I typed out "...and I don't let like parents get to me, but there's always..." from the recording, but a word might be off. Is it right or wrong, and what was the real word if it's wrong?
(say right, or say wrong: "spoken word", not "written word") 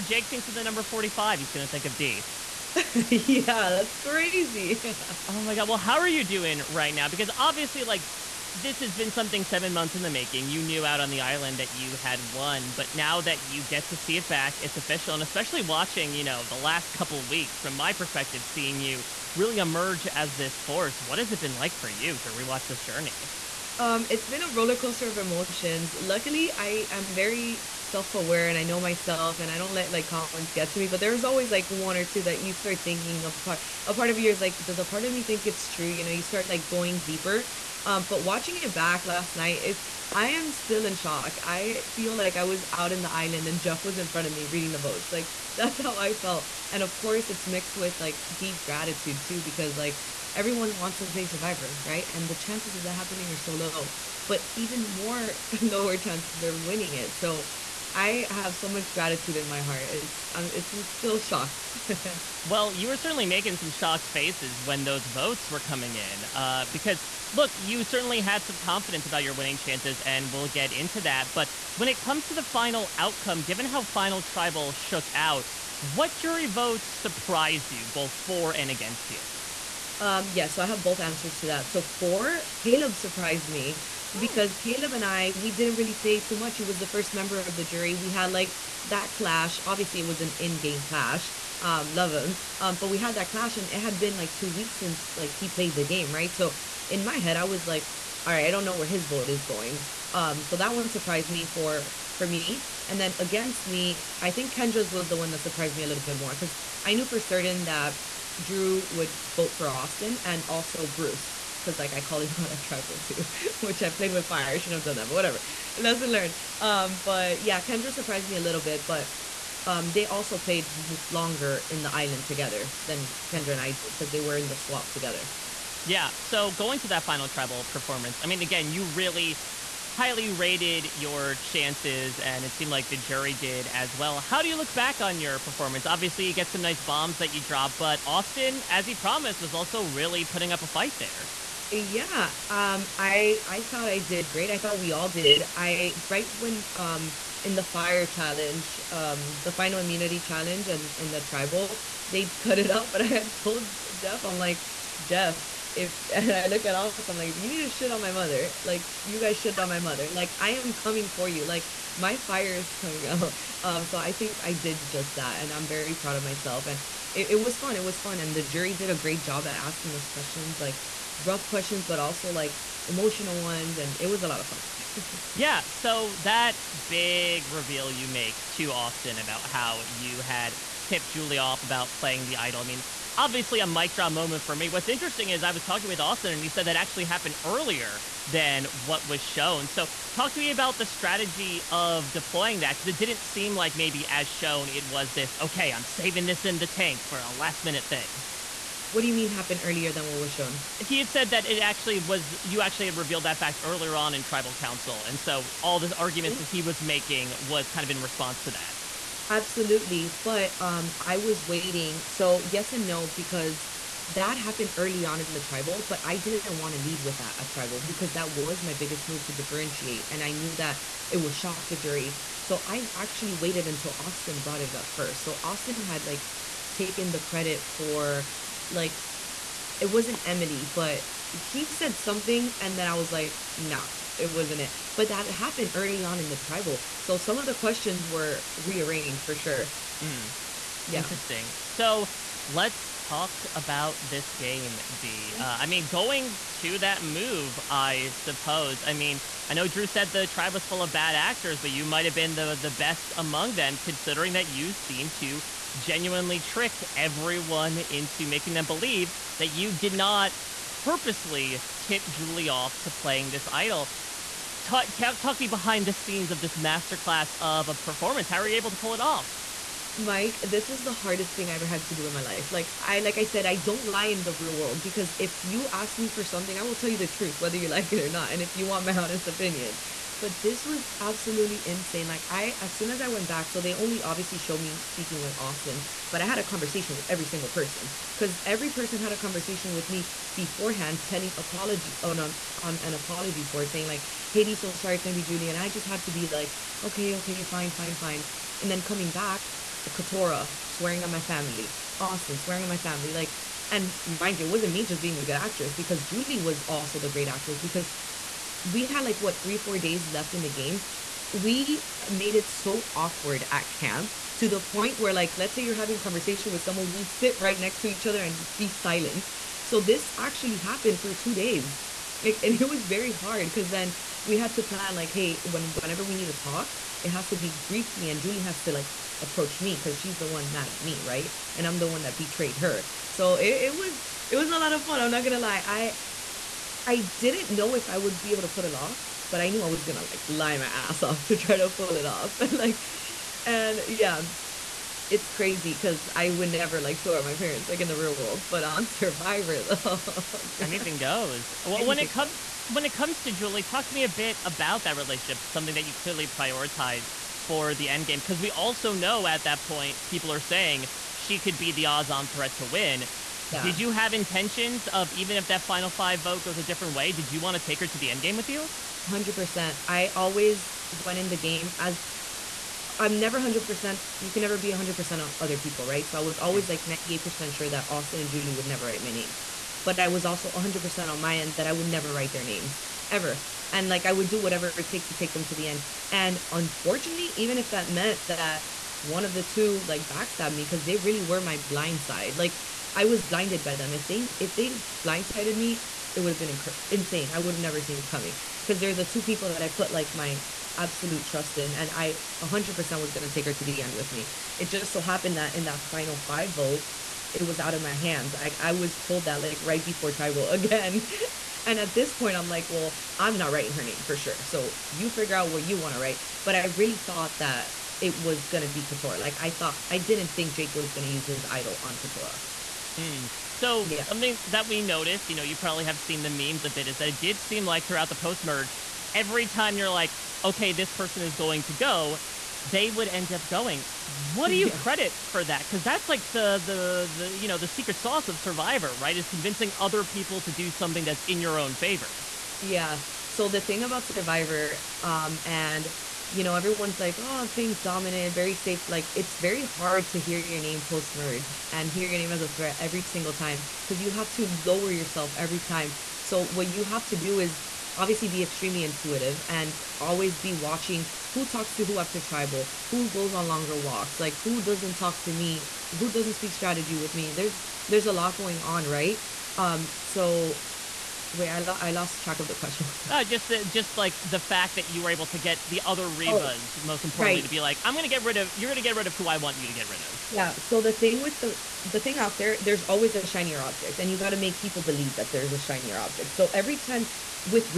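wrong: "comments", not "parents".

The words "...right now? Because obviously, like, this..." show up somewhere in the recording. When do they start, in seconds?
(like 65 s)
6 s.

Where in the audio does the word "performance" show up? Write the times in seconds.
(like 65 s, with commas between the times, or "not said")
127 s, 135 s, 267 s.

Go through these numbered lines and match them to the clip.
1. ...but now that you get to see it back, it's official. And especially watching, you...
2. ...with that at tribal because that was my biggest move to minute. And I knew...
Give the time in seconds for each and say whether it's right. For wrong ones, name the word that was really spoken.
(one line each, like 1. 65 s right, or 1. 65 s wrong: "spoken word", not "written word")
1. 12 s right
2. 217 s wrong: "differentiate", not "minute".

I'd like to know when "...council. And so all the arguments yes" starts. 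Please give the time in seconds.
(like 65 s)
204 s.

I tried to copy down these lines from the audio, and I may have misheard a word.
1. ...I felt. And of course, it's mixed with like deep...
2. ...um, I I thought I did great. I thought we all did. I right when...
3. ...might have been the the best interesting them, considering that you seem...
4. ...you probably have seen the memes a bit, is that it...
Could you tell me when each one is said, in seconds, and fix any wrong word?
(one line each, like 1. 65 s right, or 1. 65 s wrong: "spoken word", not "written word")
1. 45 s right
2. 142 s right
3. 251 s wrong: "among", not "interesting"
4. 425 s right.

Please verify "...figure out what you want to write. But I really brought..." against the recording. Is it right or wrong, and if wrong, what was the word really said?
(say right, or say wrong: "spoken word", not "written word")
wrong: "thought", not "brought".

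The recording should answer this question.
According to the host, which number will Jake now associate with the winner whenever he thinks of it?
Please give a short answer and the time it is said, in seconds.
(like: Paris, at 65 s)
45, at 0 s.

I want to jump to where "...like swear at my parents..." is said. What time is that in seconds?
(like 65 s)
346 s.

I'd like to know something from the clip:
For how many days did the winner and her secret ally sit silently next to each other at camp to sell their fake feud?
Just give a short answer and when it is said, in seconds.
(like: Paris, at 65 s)
2, at 321 s.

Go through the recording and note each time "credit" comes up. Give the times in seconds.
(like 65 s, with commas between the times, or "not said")
227 s, 434 s.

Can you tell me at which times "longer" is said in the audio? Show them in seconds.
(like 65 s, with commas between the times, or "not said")
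121 s, 463 s.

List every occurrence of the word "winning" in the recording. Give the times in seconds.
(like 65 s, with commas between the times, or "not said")
56 s, 69 s.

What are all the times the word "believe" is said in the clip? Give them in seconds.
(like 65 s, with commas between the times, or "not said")
258 s, 484 s.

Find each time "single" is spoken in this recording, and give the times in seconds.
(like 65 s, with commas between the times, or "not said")
287 s, 453 s.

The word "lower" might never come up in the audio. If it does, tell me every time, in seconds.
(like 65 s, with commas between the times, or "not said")
55 s, 454 s.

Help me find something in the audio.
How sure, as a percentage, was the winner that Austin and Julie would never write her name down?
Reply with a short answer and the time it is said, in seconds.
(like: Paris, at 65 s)
98%, at 376 s.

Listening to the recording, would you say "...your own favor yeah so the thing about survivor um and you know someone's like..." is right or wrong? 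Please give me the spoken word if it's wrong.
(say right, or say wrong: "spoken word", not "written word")
wrong: "everyone", not "someone".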